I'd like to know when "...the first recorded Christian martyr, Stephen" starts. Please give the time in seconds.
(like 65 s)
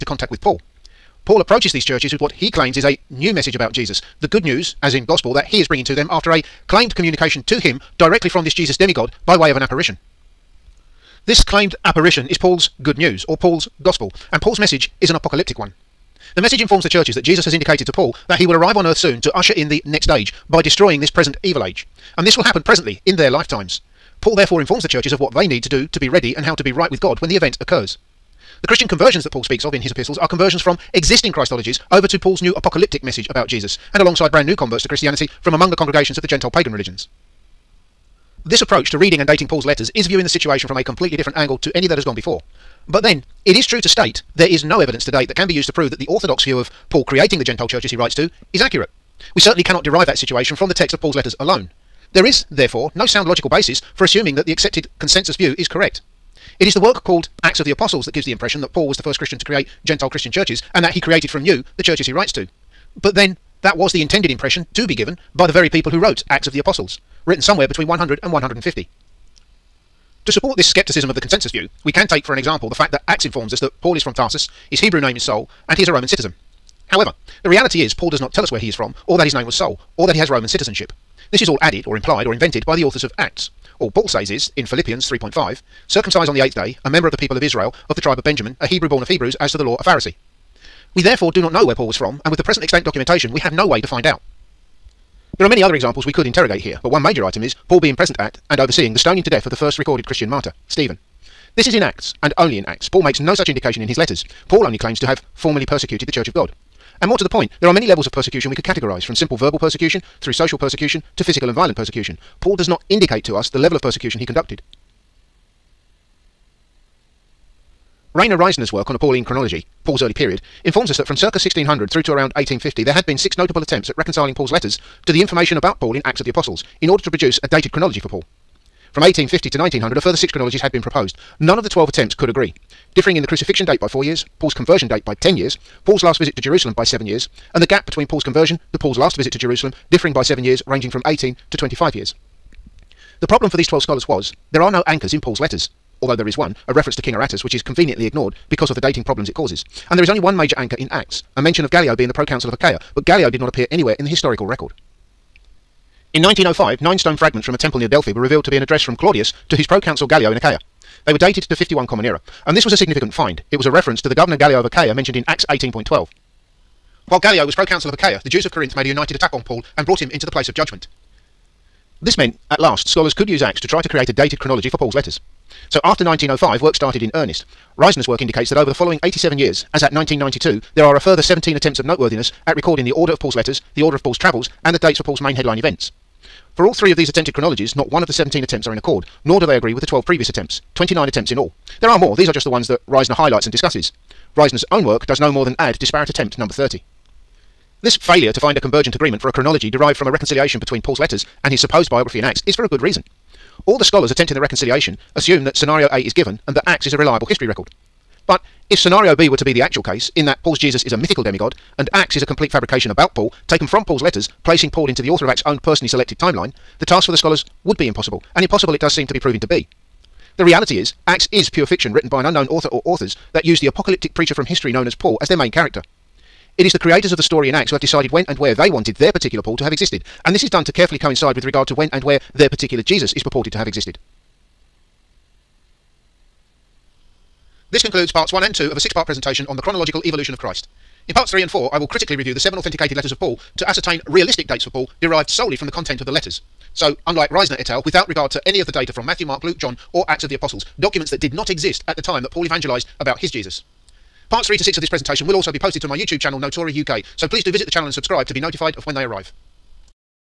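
99 s.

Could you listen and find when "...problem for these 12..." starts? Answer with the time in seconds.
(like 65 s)
143 s.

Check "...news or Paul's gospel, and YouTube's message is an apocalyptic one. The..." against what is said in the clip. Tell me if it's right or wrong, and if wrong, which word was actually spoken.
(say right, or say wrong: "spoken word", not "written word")
wrong: "Paul", not "YouTube".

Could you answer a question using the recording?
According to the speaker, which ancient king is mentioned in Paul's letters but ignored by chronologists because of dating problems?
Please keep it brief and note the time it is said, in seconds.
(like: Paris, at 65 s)
King Aretas, at 147 s.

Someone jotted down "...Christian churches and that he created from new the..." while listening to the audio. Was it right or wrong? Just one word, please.
right.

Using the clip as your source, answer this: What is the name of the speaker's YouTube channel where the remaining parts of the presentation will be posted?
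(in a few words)
Notori UK.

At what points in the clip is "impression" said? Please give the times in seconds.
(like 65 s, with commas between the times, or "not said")
58 s, 64 s.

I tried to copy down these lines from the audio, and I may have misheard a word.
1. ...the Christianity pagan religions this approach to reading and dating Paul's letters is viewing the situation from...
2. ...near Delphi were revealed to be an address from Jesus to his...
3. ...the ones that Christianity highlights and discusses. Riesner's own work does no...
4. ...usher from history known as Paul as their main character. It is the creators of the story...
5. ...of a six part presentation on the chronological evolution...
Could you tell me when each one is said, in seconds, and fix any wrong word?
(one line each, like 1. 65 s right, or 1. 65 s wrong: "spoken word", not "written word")
1. 36 s wrong: "Gentile", not "Christianity"
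2. 157 s wrong: "Claudius", not "Jesus"
3. 192 s wrong: "Riesner", not "Christianity"
4. 224 s wrong: "preacher", not "usher"
5. 238 s right.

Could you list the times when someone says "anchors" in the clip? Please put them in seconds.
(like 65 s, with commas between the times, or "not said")
144 s, 150 s.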